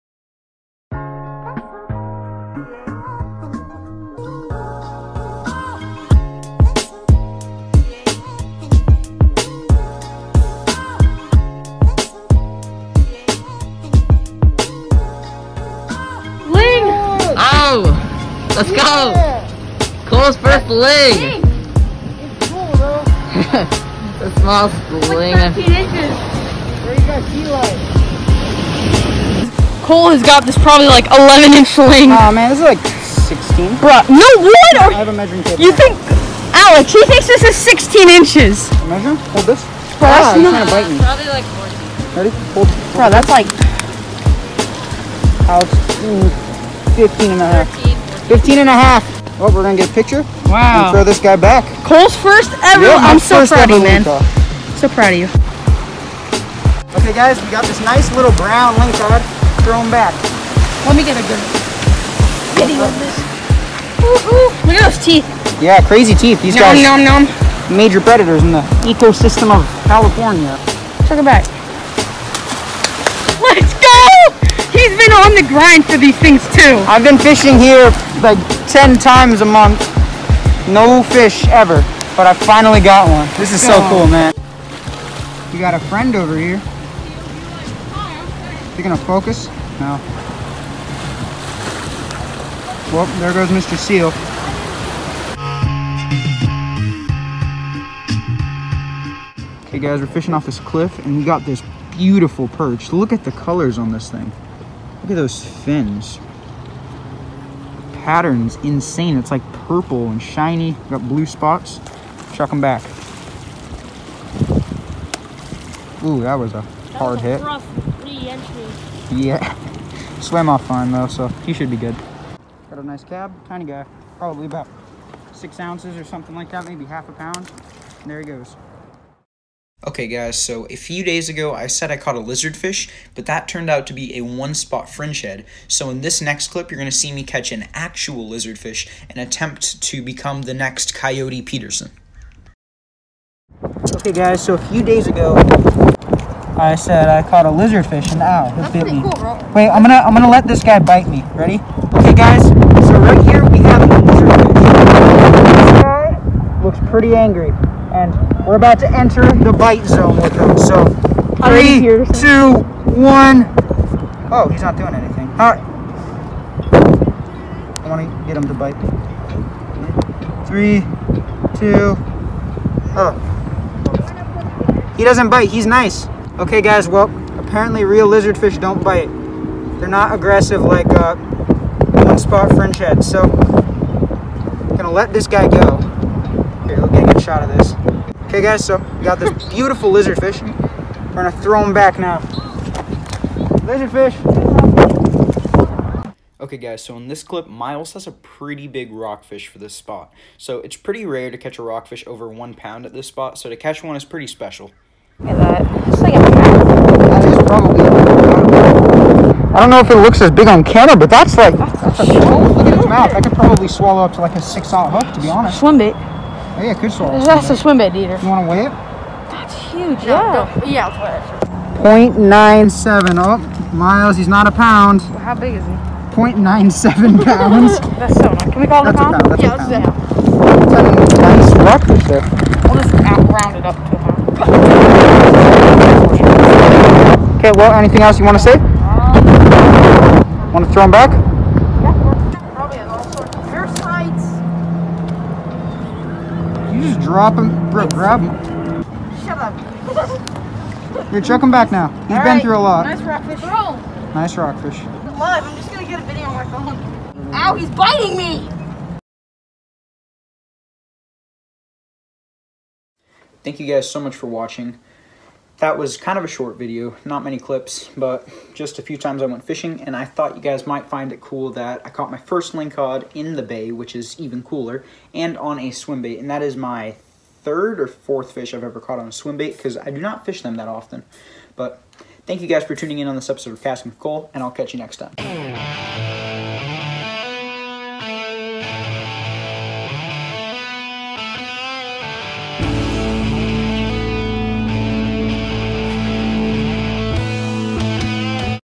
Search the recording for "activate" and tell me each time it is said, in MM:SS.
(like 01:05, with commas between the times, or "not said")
not said.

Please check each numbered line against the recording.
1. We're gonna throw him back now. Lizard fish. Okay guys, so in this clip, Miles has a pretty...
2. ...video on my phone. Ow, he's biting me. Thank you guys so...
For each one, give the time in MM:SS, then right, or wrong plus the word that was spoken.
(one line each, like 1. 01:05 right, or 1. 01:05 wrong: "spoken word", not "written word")
1. 03:10 right
2. 04:16 right.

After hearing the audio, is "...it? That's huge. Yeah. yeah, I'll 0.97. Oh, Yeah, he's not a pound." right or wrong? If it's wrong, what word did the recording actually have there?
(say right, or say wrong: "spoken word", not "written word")
wrong: "Miles", not "Yeah".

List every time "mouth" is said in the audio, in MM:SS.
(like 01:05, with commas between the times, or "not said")
03:32.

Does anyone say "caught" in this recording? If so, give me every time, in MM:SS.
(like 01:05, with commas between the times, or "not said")
02:11, 02:27, 04:31, 04:38.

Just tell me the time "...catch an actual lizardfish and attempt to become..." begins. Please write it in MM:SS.
02:17.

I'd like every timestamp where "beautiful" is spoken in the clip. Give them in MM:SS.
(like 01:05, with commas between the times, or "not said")
01:41, 03:09.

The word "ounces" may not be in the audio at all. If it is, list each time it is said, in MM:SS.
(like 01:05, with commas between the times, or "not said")
02:05, 03:34.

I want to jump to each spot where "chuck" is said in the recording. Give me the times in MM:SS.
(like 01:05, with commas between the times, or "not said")
01:52, 04:11.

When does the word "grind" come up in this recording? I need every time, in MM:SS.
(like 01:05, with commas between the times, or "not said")
01:15.